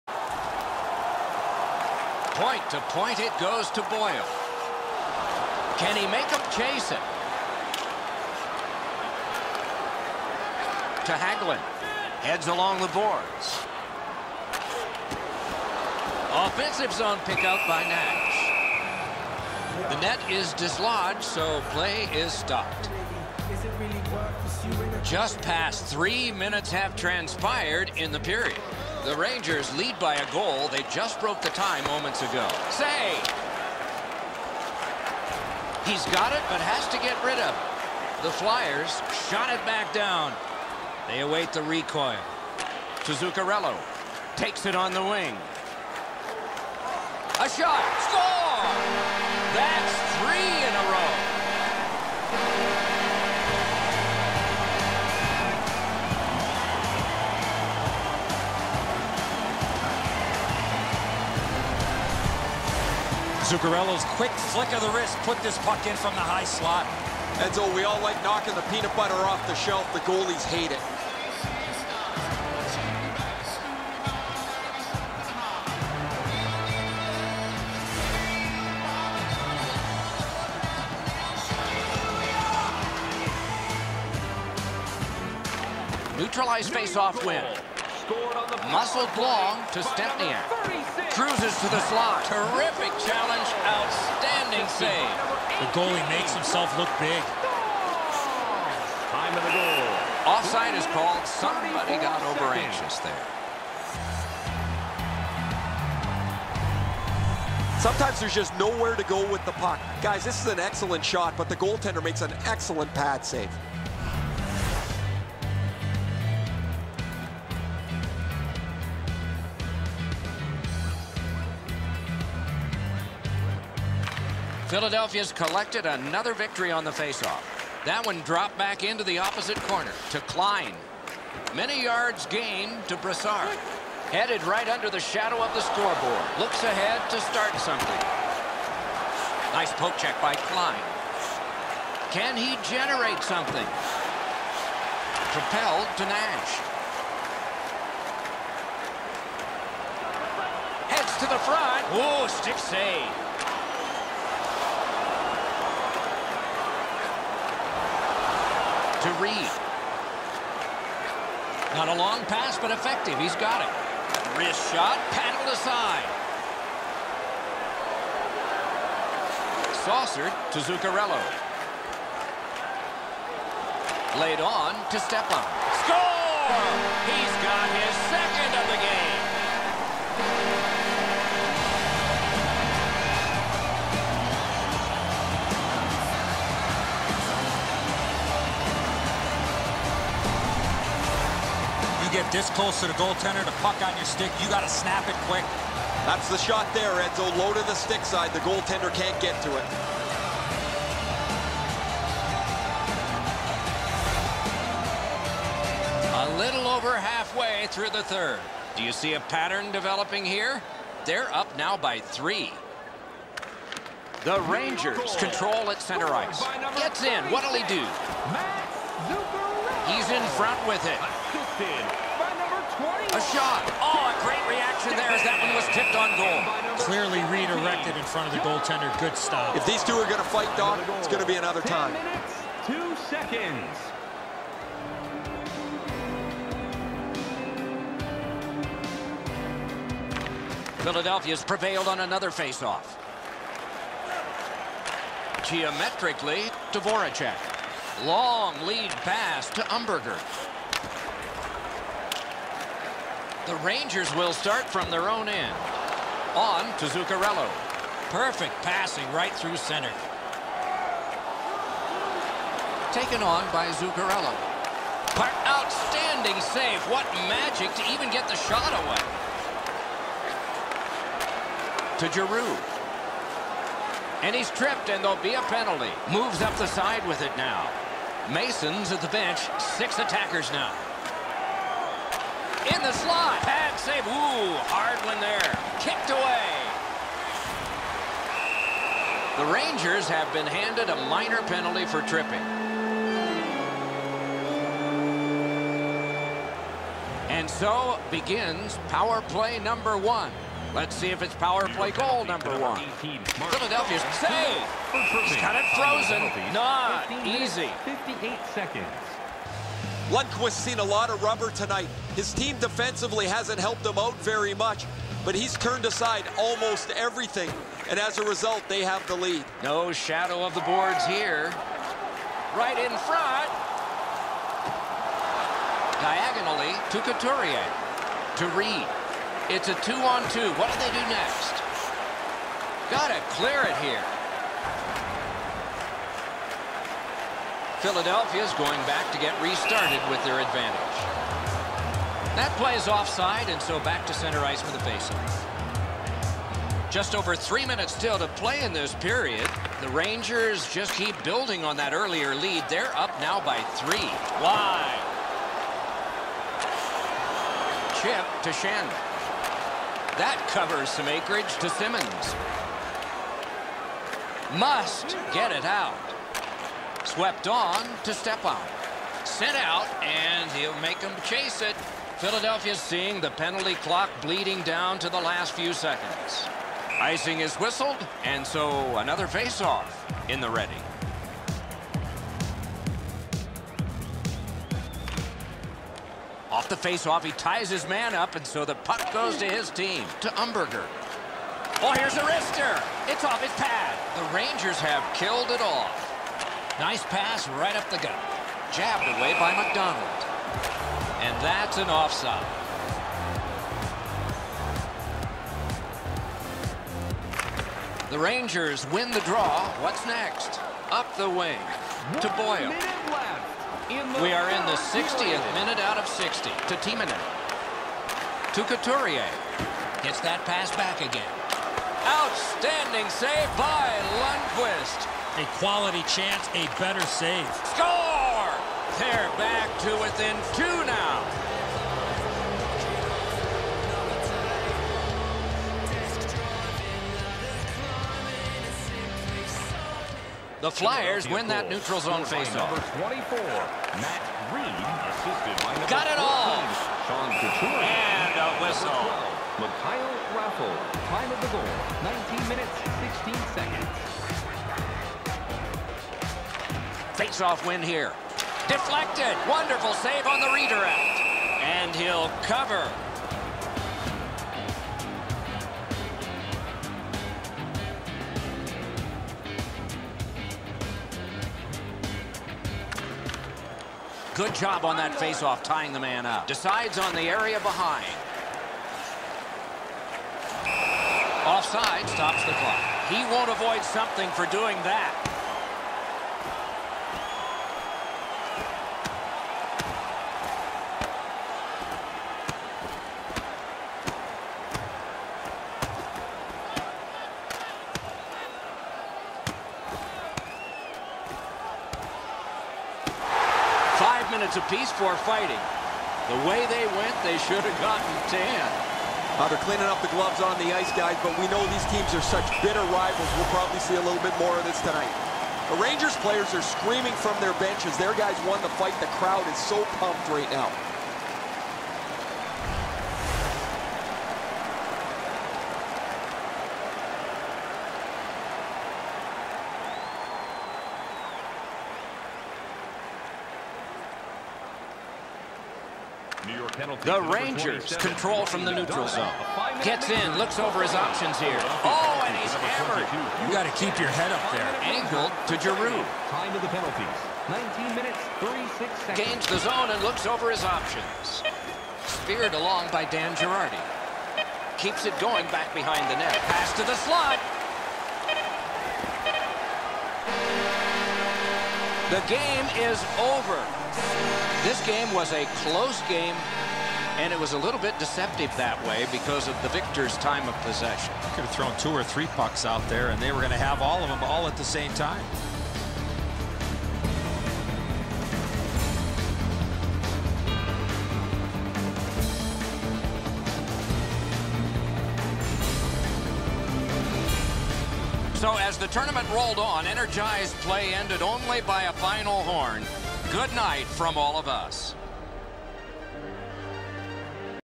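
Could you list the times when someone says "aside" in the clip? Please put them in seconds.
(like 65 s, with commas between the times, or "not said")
165 s, 315 s.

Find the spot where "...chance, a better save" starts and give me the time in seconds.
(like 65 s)
426 s.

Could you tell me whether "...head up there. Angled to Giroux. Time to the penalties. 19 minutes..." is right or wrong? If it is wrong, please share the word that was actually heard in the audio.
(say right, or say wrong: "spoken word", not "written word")
right.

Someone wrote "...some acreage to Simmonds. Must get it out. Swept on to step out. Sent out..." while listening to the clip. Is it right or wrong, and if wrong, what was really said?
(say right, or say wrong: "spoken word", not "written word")
right.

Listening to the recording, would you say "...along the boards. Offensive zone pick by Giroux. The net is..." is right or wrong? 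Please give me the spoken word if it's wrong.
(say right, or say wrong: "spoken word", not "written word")
wrong: "Nash", not "Giroux".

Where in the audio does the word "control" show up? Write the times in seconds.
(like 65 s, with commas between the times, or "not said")
215 s, 537 s.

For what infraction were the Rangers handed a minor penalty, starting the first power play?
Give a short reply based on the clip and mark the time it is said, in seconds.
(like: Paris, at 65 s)
Tripping, at 292 s.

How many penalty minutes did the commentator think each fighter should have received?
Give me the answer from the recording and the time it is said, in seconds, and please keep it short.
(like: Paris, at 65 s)
10, at 508 s.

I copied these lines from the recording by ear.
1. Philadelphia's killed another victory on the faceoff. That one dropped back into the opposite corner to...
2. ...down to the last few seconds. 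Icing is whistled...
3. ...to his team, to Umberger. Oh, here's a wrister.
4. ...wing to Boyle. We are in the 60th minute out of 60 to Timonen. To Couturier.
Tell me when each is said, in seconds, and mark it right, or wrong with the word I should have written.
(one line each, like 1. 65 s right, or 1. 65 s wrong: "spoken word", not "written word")
1. 124 s wrong: "collected", not "killed"
2. 374 s right
3. 389 s right
4. 411 s right.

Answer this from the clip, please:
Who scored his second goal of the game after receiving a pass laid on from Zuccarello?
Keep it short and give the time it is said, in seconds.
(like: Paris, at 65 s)
Stepan, at 174 s.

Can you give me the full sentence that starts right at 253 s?
The Rangers will start from their own end.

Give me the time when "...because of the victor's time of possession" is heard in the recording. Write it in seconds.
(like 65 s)
569 s.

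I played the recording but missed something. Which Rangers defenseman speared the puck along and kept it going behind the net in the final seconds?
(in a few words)
Dan Girardi.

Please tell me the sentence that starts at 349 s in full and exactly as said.
The Rangers just keep building on that earlier lead.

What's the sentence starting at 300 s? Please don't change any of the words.
Let's see if it's power play goal number one.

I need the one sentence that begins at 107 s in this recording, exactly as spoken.
Sometimes there's just nowhere to go with the puck.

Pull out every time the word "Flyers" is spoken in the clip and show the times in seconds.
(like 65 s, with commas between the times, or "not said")
38 s, 440 s.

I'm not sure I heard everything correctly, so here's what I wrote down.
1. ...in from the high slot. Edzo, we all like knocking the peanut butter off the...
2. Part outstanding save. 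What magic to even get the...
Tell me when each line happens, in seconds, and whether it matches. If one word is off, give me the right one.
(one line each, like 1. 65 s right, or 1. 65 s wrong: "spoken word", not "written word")
1. 65 s right
2. 265 s right.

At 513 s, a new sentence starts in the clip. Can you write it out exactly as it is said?
We'll probably see a little bit more of this tonight.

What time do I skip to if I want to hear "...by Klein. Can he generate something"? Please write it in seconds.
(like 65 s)
140 s.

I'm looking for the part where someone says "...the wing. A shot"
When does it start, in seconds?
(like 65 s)
44 s.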